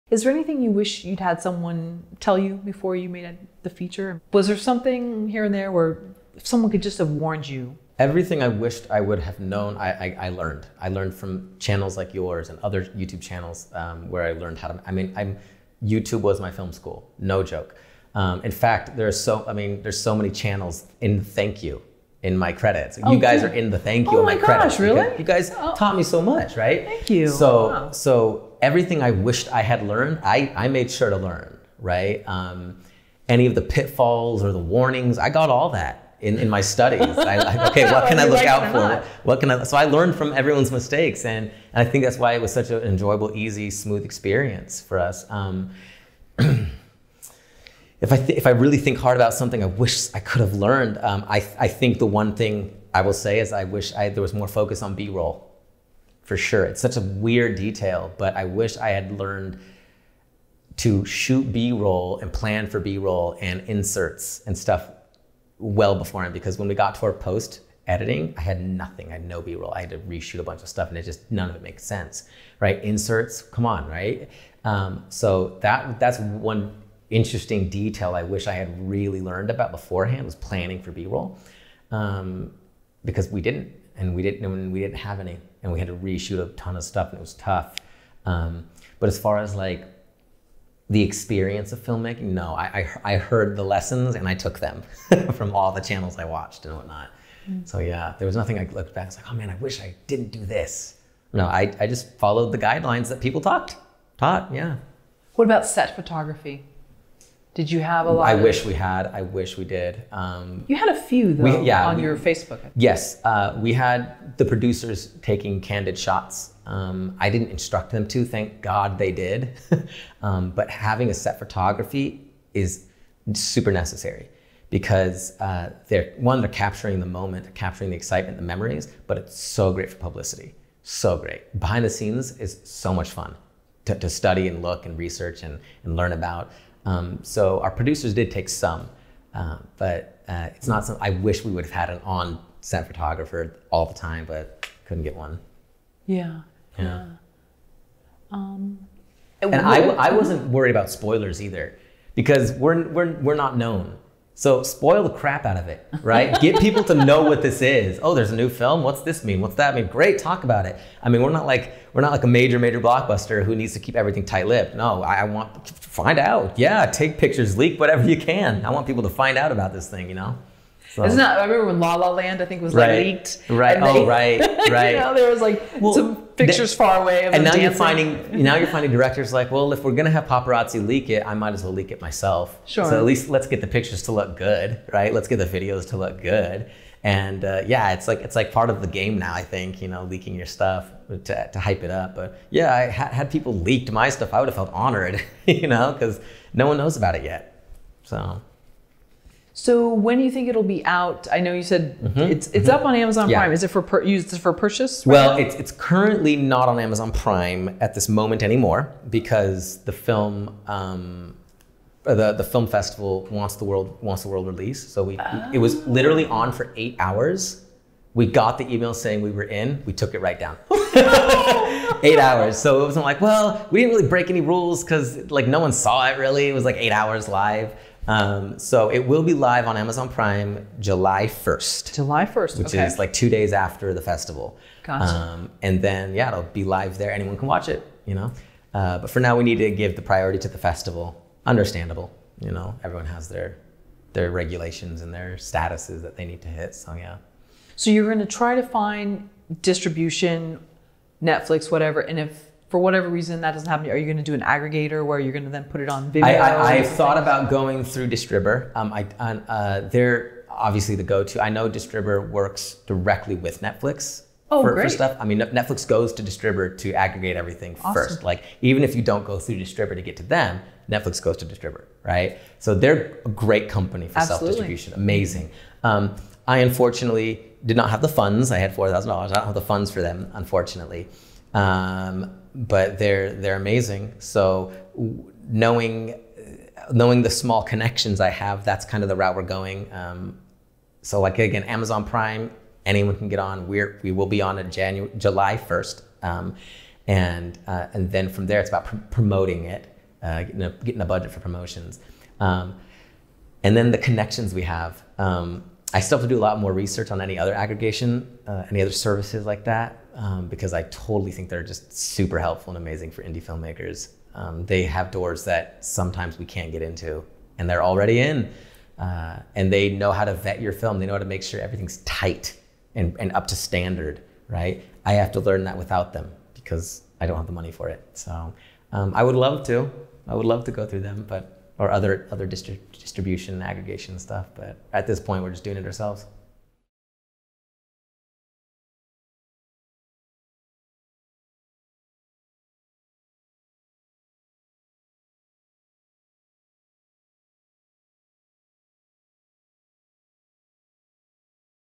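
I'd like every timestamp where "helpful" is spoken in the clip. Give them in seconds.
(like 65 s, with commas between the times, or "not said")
312 s.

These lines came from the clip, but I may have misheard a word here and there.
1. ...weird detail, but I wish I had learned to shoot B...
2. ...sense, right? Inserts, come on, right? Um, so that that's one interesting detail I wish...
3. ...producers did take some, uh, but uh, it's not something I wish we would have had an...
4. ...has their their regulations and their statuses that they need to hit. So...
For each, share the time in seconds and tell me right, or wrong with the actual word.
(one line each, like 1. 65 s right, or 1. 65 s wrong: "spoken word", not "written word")
1. 57 s right
2. 71 s right
3. 137 s right
4. 243 s right.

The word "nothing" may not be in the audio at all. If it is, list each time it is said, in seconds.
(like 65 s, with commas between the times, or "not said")
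68 s, 98 s.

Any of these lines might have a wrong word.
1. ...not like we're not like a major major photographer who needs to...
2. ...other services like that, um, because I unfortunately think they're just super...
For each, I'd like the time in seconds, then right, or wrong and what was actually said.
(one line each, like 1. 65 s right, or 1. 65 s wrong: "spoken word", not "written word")
1. 161 s wrong: "blockbuster", not "photographer"
2. 308 s wrong: "totally", not "unfortunately".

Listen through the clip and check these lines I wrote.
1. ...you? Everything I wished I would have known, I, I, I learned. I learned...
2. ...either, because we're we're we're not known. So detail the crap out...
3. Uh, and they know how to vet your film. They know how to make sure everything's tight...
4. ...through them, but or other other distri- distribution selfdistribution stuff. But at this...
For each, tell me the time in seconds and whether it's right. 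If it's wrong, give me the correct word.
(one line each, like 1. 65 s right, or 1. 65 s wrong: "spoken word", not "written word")
1. 7 s right
2. 151 s wrong: "spoil", not "detail"
3. 318 s right
4. 330 s wrong: "aggregation", not "selfdistribution".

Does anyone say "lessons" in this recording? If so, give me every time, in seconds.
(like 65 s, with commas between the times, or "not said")
93 s.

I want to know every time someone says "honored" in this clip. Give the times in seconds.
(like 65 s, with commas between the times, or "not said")
194 s.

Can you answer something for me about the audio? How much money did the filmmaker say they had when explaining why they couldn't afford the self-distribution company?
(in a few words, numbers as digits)
$4,000.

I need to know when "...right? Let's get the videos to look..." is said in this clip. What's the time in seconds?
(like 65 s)
184 s.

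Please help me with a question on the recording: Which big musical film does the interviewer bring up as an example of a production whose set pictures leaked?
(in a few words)
La La Land.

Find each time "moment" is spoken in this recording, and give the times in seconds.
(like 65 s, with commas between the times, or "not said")
127 s, 208 s.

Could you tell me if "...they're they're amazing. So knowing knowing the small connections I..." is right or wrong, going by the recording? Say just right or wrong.
right.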